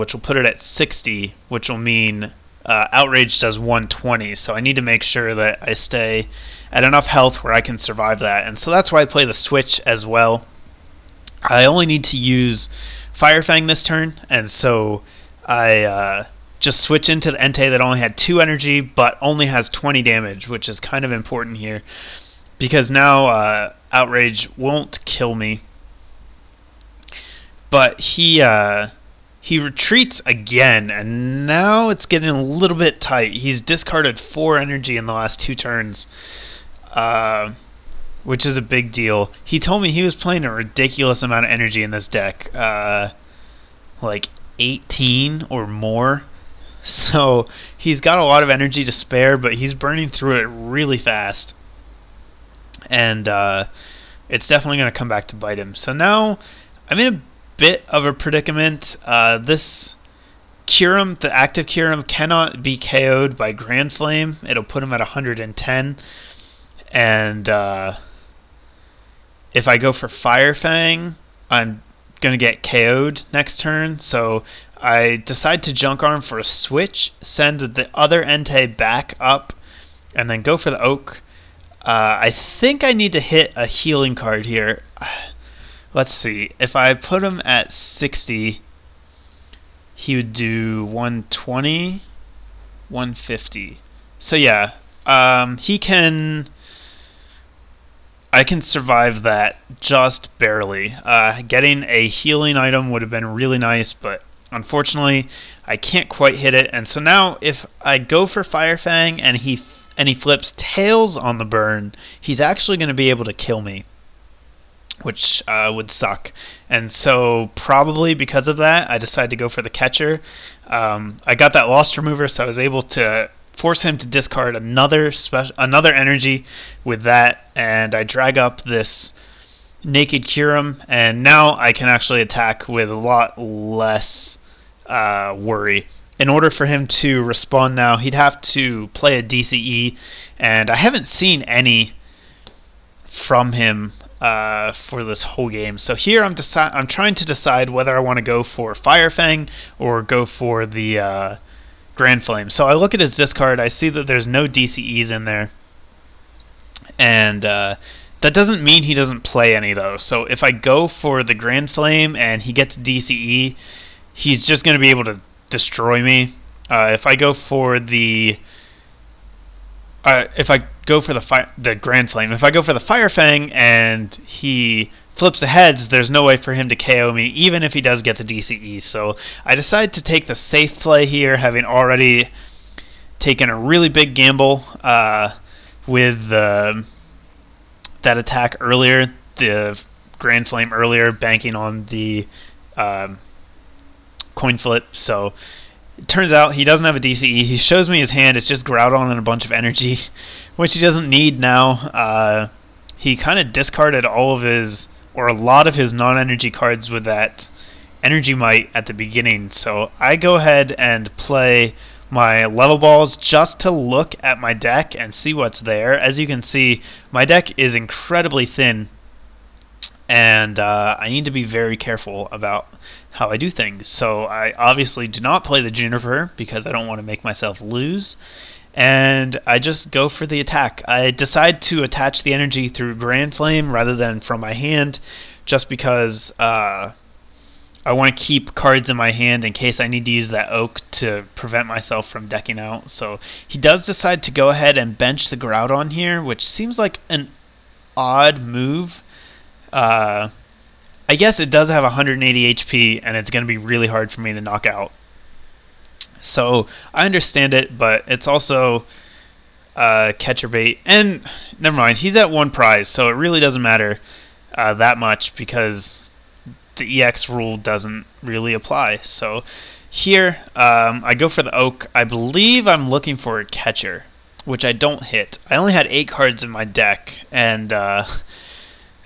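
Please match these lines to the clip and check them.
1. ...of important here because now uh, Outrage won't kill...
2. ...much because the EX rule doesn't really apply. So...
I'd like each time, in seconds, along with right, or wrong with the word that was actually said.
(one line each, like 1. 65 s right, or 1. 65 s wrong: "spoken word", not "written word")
1. 21 s right
2. 264 s right.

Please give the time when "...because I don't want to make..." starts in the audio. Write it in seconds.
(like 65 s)
226 s.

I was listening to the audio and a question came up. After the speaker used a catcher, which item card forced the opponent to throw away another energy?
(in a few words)
Lost Remover.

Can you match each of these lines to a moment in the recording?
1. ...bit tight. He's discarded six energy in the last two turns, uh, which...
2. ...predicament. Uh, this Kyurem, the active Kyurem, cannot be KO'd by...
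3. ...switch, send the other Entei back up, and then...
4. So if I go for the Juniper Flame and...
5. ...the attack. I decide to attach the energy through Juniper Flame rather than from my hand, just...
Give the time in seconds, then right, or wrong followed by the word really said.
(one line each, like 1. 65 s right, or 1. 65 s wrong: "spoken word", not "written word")
1. 32 s wrong: "four", not "six"
2. 58 s right
3. 76 s right
4. 159 s wrong: "Grand", not "Juniper"
5. 230 s wrong: "Grand", not "Juniper".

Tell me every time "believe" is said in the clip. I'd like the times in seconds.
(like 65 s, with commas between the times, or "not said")
272 s.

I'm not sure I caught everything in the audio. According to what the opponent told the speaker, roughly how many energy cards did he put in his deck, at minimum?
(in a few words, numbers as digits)
18.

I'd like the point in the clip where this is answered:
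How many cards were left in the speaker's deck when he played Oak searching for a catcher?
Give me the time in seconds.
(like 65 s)
275 s.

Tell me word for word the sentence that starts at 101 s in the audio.
Uh, getting a healing item would have been really nice, but unfortunately, I can't quite hit it.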